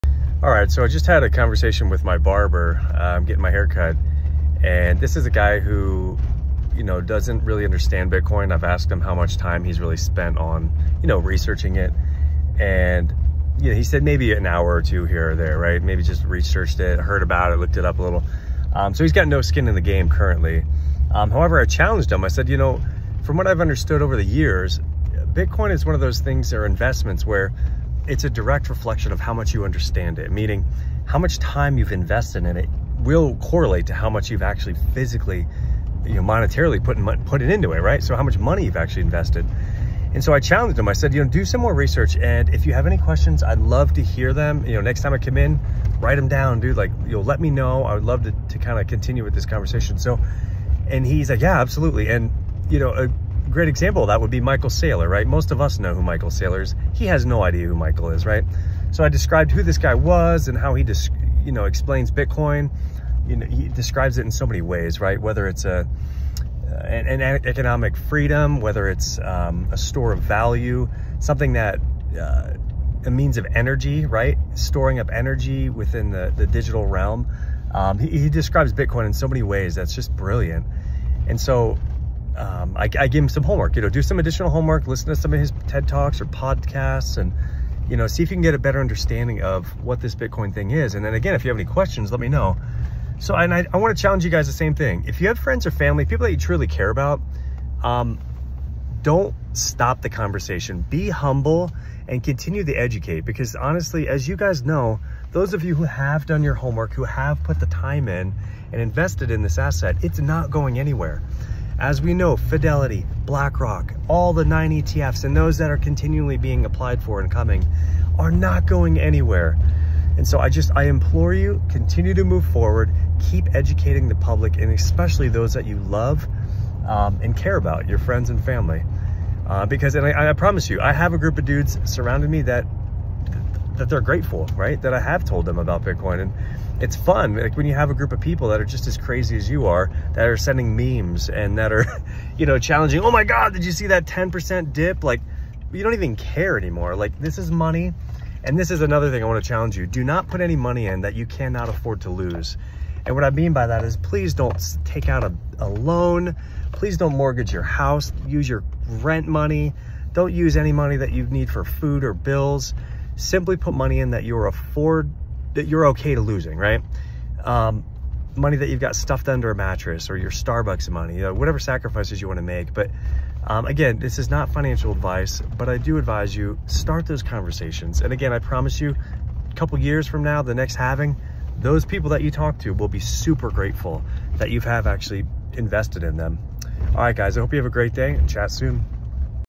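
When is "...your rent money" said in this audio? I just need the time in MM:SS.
02:38.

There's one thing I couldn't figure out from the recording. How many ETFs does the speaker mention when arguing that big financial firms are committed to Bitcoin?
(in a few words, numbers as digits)
9.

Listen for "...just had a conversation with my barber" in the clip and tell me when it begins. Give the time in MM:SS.
00:00.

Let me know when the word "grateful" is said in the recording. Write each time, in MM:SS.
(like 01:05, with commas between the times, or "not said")
02:14, 03:03.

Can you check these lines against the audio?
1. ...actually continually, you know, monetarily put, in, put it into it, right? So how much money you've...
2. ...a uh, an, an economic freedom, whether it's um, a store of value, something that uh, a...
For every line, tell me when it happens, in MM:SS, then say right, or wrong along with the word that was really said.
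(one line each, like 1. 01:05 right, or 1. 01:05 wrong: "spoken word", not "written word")
1. 00:34 wrong: "physically", not "continually"
2. 01:05 right.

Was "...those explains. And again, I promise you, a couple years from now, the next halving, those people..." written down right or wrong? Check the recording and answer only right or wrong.
wrong.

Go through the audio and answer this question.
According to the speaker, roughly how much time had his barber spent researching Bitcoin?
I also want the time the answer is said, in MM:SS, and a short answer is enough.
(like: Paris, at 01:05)
an hour or two, at 00:14.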